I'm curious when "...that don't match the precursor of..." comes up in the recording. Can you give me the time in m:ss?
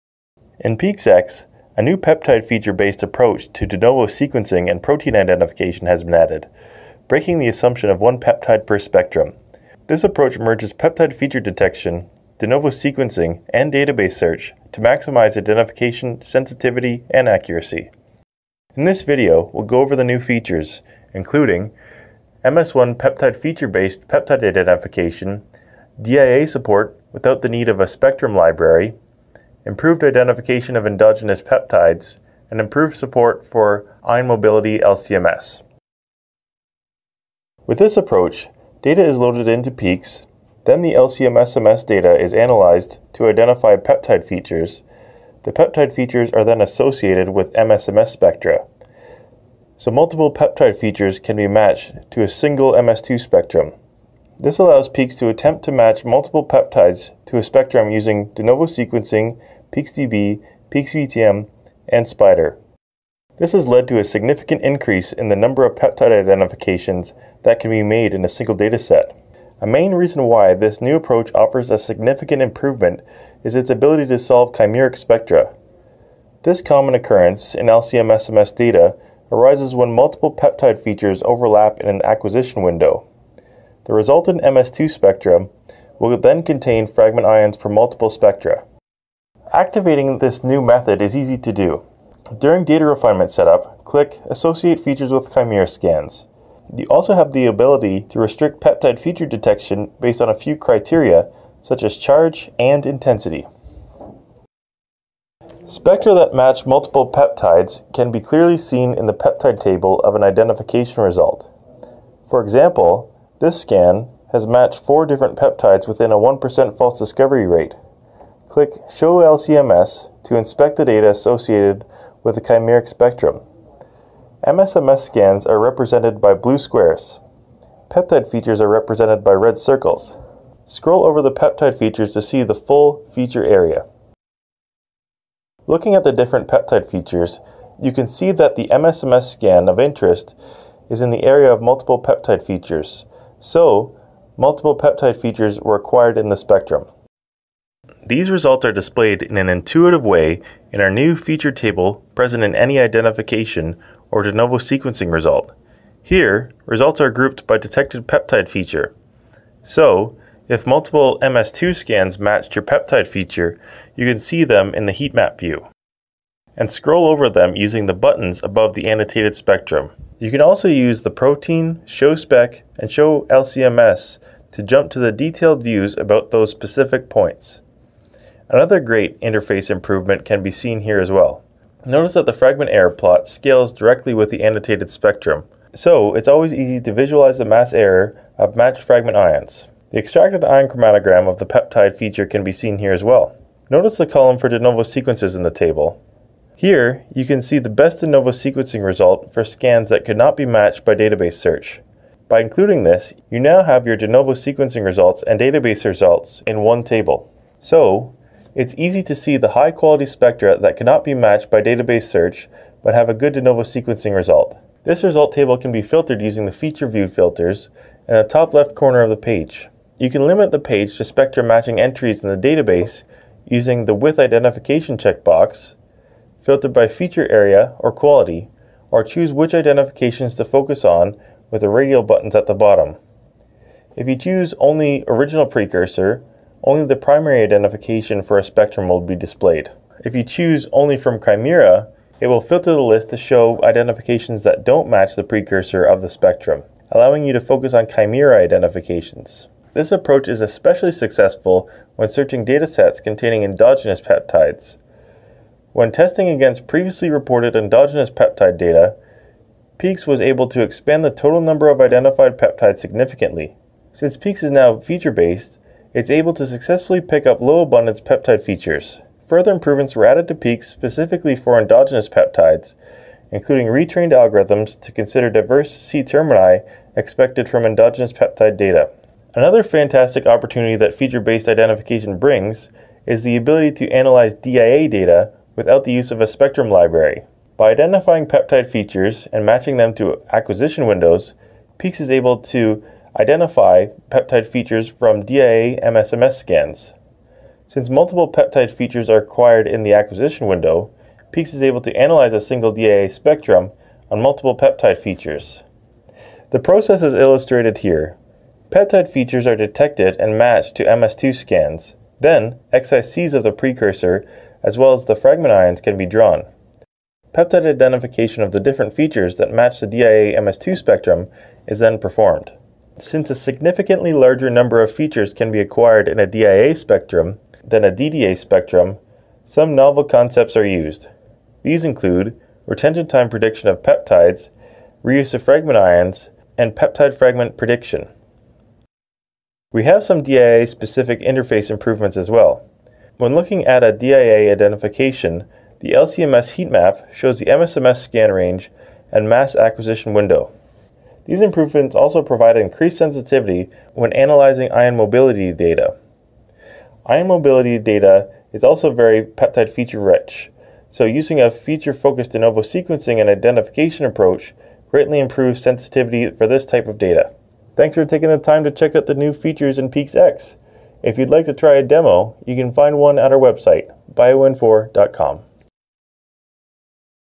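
4:04.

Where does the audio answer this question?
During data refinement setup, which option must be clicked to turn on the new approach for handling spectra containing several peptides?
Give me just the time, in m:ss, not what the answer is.
1:34.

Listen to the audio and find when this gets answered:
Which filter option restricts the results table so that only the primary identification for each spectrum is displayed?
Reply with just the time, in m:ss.
3:54.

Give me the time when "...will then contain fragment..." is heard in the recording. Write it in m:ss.
1:25.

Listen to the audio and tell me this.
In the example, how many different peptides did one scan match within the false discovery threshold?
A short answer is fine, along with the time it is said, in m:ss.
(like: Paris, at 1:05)
4, at 1:54.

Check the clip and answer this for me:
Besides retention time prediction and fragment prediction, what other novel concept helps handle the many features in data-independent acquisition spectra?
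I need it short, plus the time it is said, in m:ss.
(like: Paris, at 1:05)
reuse of fragment ions, at 5:35.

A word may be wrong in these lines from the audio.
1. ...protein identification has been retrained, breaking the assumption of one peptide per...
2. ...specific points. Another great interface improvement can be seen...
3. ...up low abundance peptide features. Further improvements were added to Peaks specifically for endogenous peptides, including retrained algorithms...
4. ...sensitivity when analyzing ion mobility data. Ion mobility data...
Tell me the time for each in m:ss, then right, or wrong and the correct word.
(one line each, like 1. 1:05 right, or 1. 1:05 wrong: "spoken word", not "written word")
1. 0:04 wrong: "added", not "retrained"
2. 2:56 right
3. 4:27 right
4. 5:52 right.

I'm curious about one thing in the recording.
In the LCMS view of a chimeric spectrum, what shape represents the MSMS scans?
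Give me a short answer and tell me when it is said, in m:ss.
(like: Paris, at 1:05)
blue squares, at 2:06.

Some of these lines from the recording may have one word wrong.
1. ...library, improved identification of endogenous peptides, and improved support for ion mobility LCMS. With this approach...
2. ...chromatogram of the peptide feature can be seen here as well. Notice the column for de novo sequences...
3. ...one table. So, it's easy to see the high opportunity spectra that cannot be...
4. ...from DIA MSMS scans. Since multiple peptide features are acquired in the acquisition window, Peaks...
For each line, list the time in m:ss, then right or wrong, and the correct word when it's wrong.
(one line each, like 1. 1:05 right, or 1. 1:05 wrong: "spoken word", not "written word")
1. 0:28 right
2. 3:10 right
3. 3:26 wrong: "quality", not "opportunity"
4. 4:54 right.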